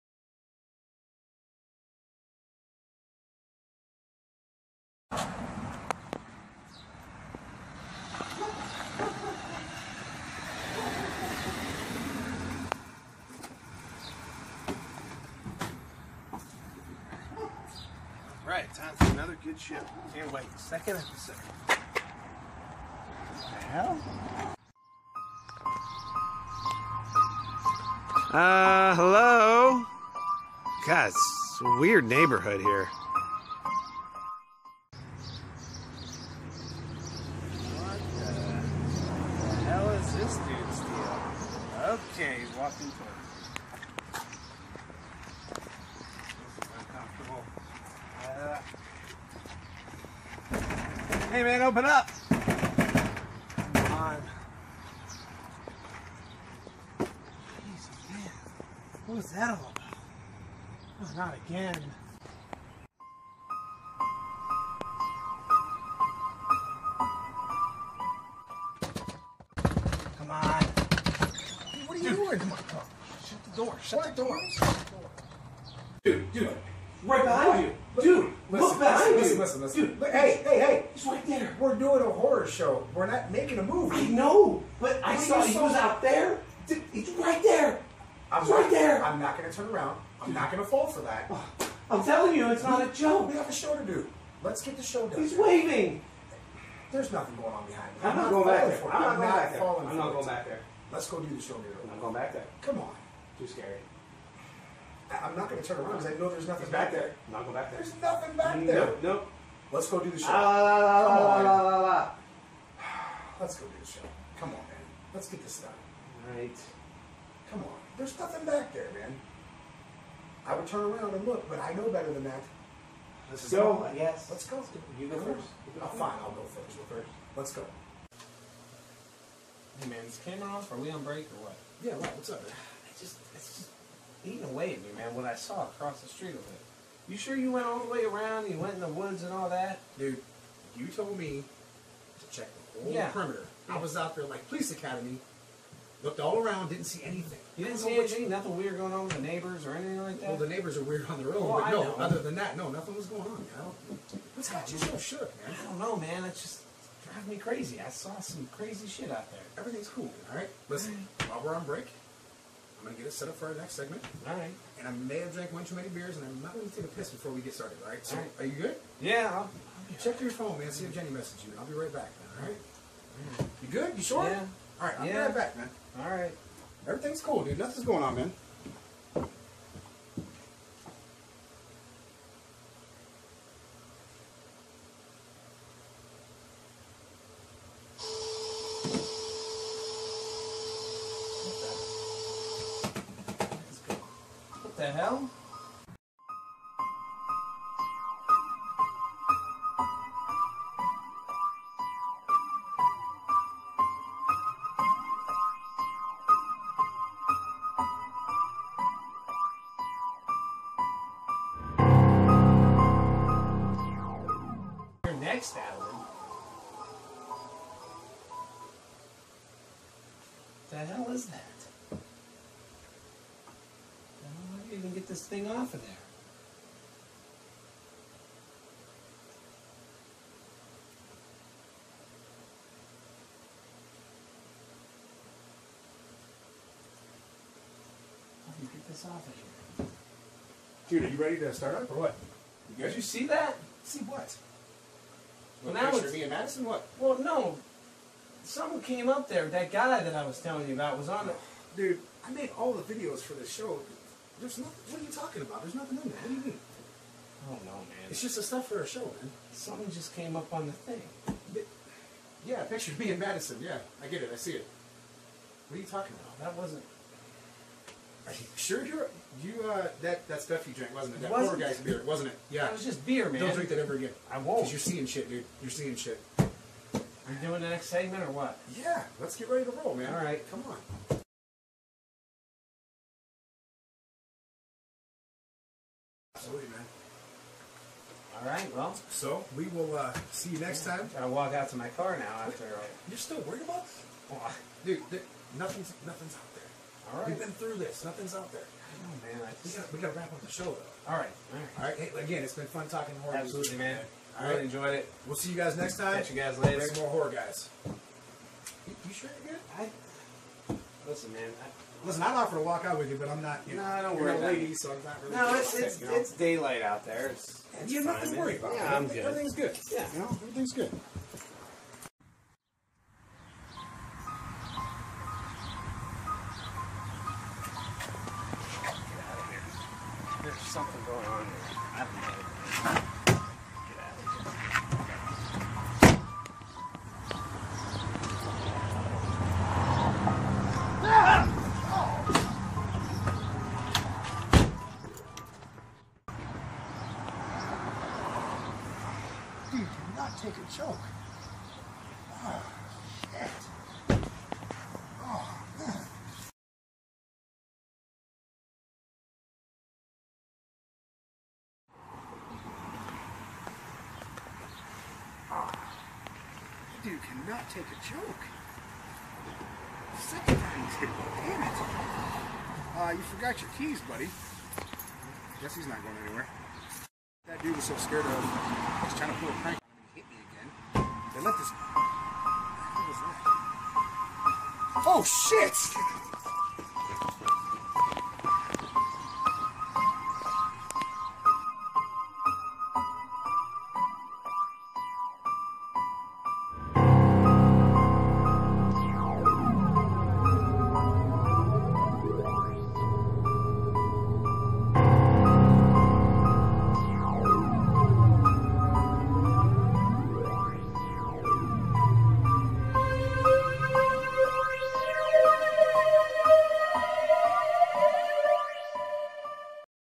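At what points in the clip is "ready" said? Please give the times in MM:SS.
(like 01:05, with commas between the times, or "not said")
04:01, 04:39.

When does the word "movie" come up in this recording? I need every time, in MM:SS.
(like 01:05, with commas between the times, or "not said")
01:23.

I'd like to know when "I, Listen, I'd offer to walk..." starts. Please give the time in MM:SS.
05:11.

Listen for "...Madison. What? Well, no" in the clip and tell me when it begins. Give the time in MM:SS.
04:06.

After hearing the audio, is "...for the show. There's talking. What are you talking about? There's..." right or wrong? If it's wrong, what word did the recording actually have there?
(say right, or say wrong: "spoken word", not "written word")
wrong: "nothing", not "talking".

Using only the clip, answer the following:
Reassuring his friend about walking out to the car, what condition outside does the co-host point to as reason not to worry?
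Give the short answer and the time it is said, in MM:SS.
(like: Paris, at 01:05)
Daylight, at 05:16.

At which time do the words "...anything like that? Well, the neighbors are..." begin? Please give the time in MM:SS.
02:29.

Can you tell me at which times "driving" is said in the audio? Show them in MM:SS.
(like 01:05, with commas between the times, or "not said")
02:37.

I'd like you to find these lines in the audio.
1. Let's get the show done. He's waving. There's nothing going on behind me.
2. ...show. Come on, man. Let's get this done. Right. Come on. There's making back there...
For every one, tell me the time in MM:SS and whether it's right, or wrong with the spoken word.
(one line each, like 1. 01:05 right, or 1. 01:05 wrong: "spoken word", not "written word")
1. 01:34 right
2. 01:53 wrong: "nothing", not "making".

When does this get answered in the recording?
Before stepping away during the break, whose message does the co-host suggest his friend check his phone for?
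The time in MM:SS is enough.
02:50.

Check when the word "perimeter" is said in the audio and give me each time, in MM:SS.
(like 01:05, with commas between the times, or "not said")
02:23.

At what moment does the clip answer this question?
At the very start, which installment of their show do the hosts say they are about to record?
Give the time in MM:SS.
00:20.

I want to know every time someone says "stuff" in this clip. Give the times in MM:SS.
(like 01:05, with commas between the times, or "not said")
04:18, 04:30.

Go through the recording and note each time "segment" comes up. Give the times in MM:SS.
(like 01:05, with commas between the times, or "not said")
02:43, 04:37.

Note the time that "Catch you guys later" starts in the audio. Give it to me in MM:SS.
05:06.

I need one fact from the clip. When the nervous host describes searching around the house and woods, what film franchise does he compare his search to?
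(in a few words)
Police Academy.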